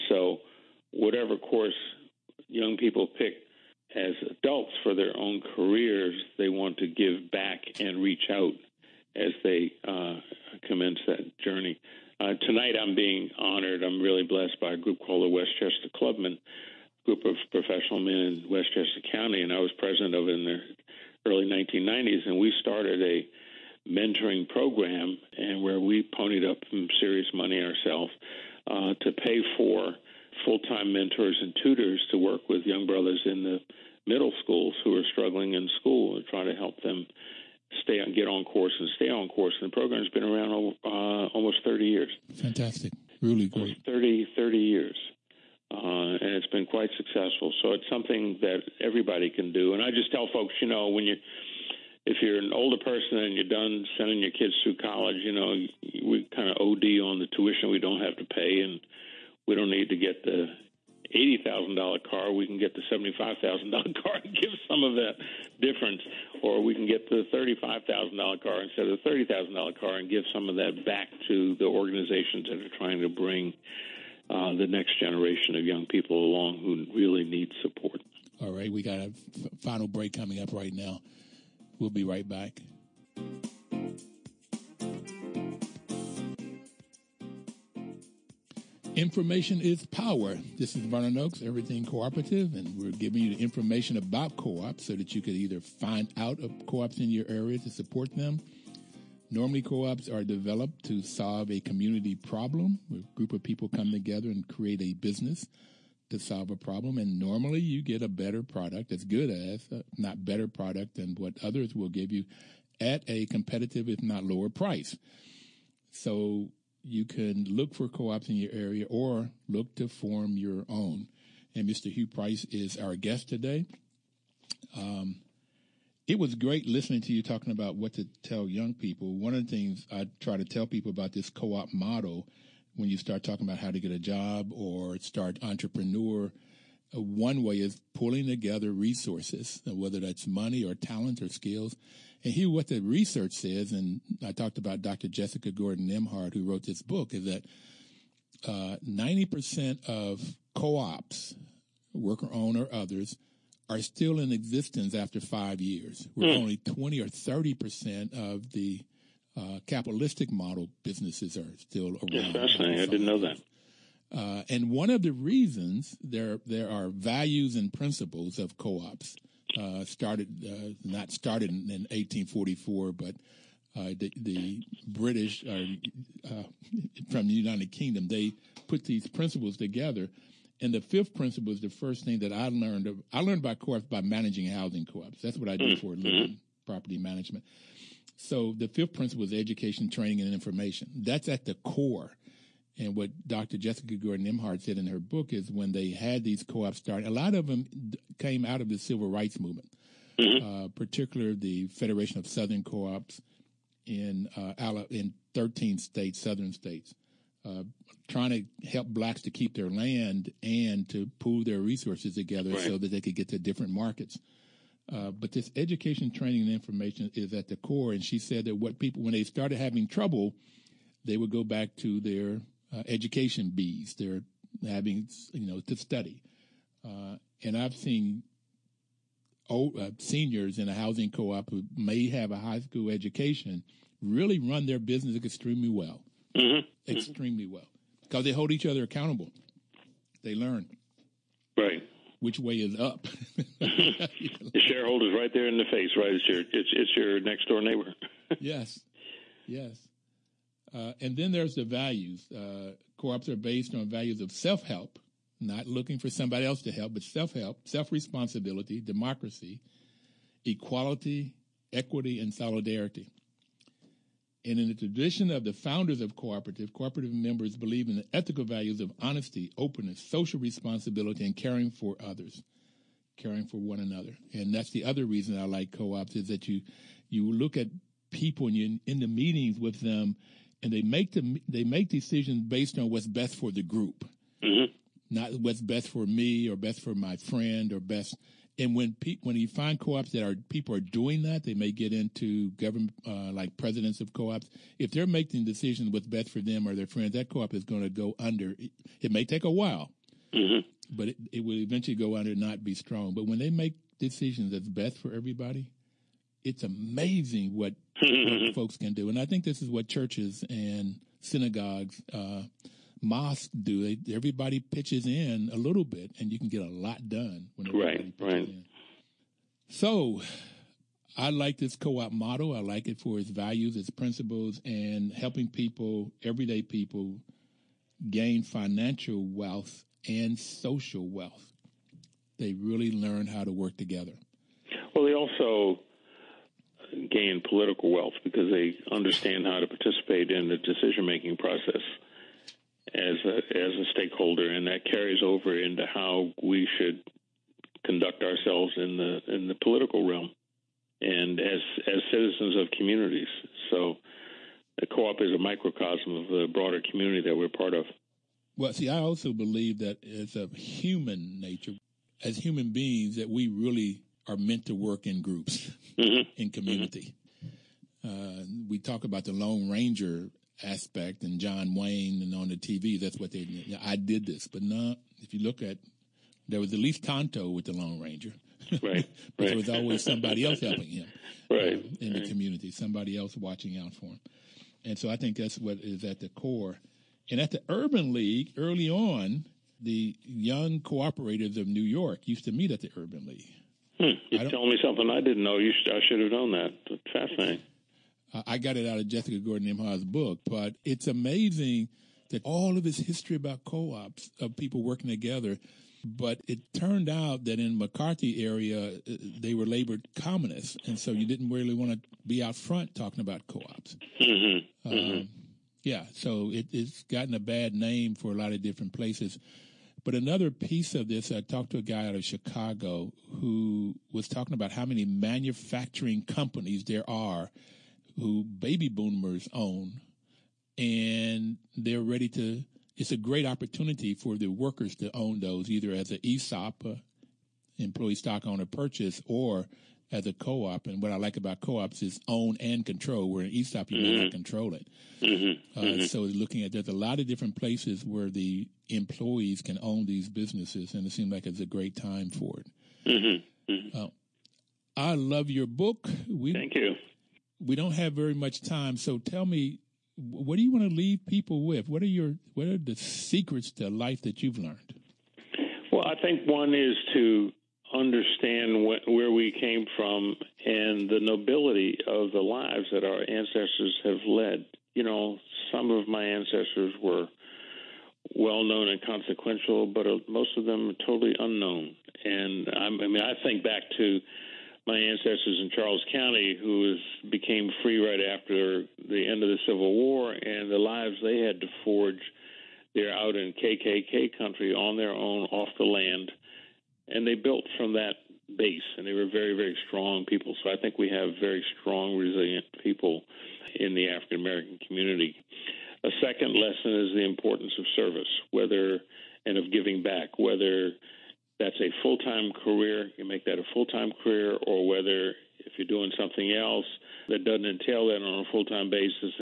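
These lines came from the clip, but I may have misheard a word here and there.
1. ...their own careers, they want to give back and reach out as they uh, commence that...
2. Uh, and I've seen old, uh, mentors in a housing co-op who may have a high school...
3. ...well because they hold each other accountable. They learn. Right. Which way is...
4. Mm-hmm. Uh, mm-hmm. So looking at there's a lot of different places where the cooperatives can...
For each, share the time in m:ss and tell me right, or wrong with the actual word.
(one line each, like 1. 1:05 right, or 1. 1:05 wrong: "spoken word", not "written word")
1. 0:04 right
2. 3:46 wrong: "seniors", not "mentors"
3. 3:57 right
4. 7:25 wrong: "employees", not "cooperatives".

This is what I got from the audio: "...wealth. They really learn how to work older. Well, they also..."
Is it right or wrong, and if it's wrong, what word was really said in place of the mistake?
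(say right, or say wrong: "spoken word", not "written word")
wrong: "together", not "older".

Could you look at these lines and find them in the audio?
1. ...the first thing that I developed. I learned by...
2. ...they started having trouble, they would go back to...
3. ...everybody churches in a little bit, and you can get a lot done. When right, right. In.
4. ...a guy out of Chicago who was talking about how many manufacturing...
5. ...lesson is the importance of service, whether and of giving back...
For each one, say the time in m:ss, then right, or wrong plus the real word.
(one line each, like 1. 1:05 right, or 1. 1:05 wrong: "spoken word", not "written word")
1. 3:01 wrong: "learned", not "developed"
2. 3:39 right
3. 5:14 wrong: "pitches", not "churches"
4. 7:01 right
5. 8:26 right.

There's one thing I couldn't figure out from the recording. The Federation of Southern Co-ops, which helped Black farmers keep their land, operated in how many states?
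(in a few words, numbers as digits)
13.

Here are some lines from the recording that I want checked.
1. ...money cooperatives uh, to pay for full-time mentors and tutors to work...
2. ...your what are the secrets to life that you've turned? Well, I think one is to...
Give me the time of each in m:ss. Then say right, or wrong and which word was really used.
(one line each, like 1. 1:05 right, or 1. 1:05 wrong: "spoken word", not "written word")
1. 0:27 wrong: "ourselves", not "cooperatives"
2. 7:42 wrong: "learned", not "turned".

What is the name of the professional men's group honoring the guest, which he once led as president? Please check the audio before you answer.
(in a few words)
Westchester Clubmen.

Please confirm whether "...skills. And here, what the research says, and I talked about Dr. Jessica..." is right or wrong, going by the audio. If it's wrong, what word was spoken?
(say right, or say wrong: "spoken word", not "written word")
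right.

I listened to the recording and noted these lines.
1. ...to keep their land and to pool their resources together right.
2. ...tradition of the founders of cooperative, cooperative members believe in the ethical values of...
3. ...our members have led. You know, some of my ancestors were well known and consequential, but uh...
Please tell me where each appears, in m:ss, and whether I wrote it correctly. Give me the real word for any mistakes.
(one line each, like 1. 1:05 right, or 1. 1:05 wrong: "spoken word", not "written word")
1. 3:29 right
2. 4:24 right
3. 7:53 wrong: "ancestors", not "members".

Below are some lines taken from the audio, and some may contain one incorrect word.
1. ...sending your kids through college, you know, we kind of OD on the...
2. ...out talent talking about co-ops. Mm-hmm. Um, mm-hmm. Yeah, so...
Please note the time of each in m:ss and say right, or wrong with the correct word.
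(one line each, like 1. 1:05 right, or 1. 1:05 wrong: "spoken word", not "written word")
1. 0:53 right
2. 6:52 wrong: "front", not "talent".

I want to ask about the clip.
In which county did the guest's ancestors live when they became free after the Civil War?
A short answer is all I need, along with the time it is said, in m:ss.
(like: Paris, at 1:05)
Charles County, at 8:05.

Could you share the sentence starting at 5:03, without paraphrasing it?
But when they make decisions that's best for everybody, it's amazing what mm-hmm.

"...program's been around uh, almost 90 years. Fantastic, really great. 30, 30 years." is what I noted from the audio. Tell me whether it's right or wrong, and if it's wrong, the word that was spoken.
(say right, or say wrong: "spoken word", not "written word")
wrong: "30", not "90".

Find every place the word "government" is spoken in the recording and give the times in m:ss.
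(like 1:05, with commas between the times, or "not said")
4:52.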